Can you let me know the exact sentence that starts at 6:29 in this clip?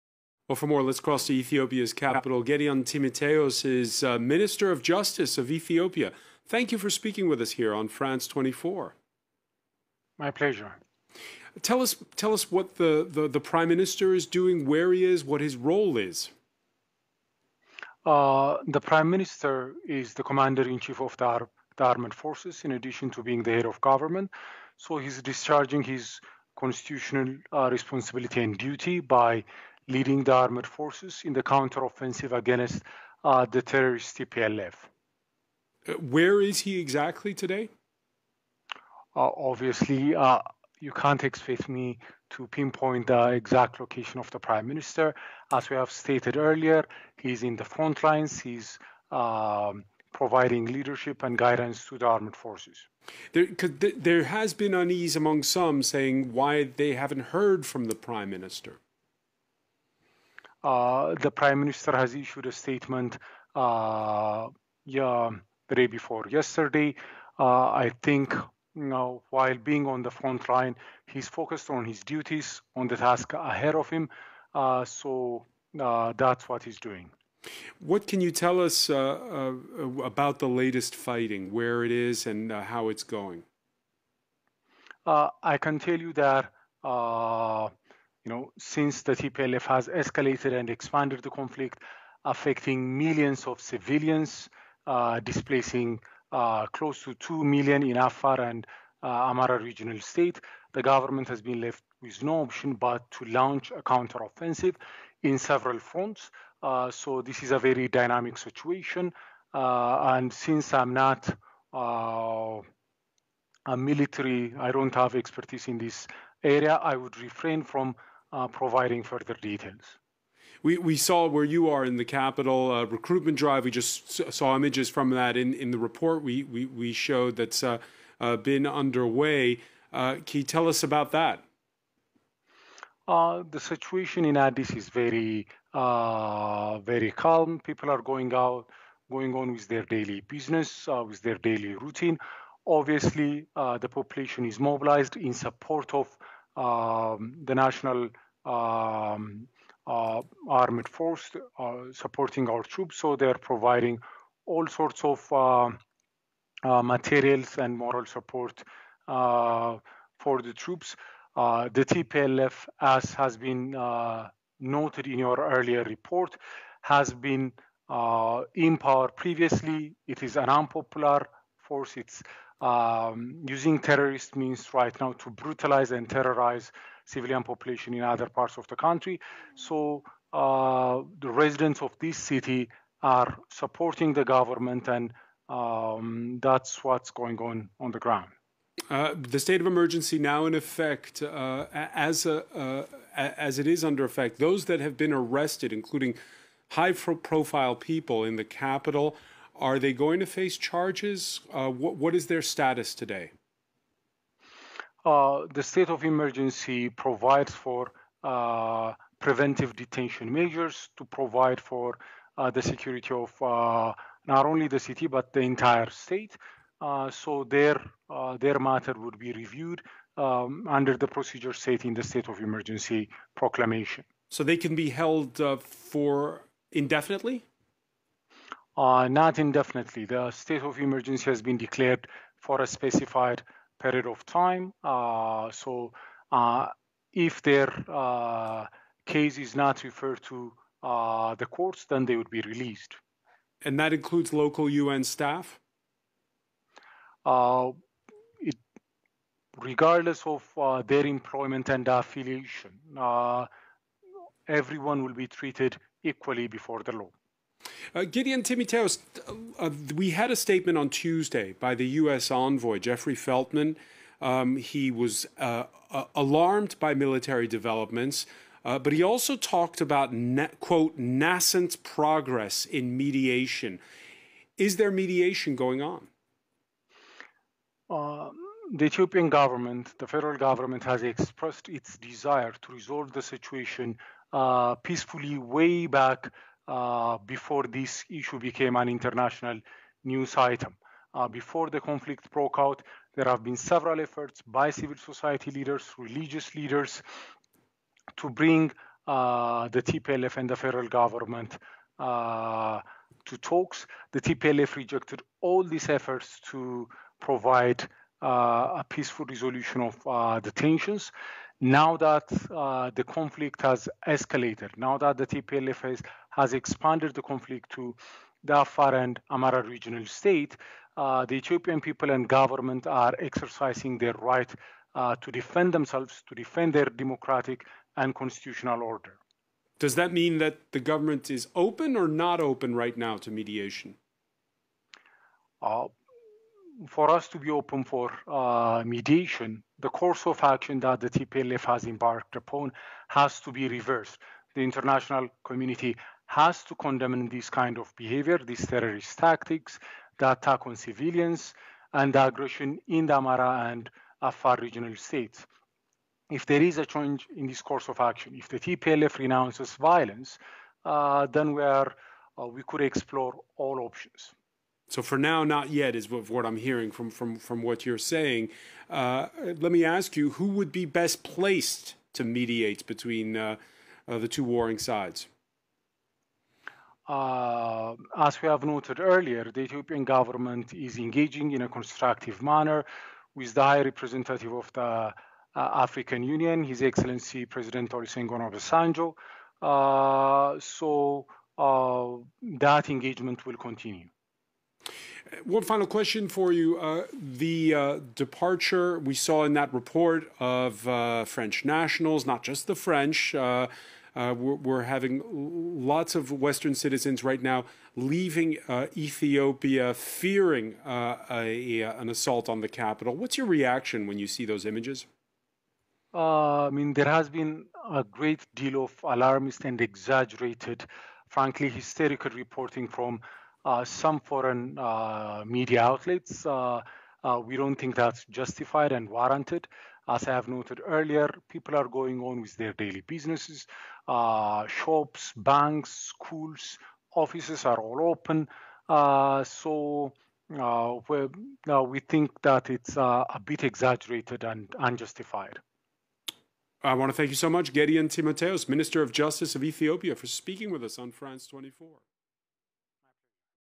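Uh, so that engagement will continue.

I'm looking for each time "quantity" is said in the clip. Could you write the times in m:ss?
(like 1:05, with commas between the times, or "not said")
not said.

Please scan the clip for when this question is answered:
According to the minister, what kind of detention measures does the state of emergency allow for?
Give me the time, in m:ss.
3:29.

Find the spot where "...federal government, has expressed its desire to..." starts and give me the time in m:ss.
4:40.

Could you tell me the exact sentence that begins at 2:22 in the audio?
Obviously, the population is mobilized in support of um, the national um, uh, armed force uh, supporting our troops.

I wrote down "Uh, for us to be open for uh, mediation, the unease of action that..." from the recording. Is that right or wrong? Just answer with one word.
wrong.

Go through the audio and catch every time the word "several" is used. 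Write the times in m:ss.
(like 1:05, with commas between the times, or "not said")
1:45, 4:53.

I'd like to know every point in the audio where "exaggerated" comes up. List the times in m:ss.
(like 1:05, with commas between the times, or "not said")
6:59, 7:23.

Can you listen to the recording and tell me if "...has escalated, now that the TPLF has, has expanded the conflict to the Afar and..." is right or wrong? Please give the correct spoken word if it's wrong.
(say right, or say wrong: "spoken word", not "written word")
right.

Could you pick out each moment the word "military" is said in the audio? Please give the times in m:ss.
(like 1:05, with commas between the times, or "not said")
1:53, 4:26.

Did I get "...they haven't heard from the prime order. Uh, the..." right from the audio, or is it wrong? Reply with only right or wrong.
wrong.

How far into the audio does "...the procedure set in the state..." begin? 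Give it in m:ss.
3:40.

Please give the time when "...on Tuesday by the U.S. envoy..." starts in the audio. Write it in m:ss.
4:20.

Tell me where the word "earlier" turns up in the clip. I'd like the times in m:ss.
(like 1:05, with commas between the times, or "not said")
0:46, 2:45, 6:18, 7:10.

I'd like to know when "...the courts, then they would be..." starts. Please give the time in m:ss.
4:01.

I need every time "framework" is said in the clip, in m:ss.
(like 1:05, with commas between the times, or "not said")
not said.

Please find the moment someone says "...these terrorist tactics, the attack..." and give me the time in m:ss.
5:48.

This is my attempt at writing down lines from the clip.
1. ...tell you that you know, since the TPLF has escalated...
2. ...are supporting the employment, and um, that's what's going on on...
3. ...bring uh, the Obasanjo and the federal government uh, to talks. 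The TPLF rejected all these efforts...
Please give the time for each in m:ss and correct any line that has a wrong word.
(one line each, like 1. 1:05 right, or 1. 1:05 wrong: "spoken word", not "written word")
1. 1:25 right
2. 3:03 wrong: "government", not "employment"
3. 4:58 wrong: "TPLF", not "Obasanjo".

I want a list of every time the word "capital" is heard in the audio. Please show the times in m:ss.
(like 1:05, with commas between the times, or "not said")
0:01, 2:02, 3:18, 6:52.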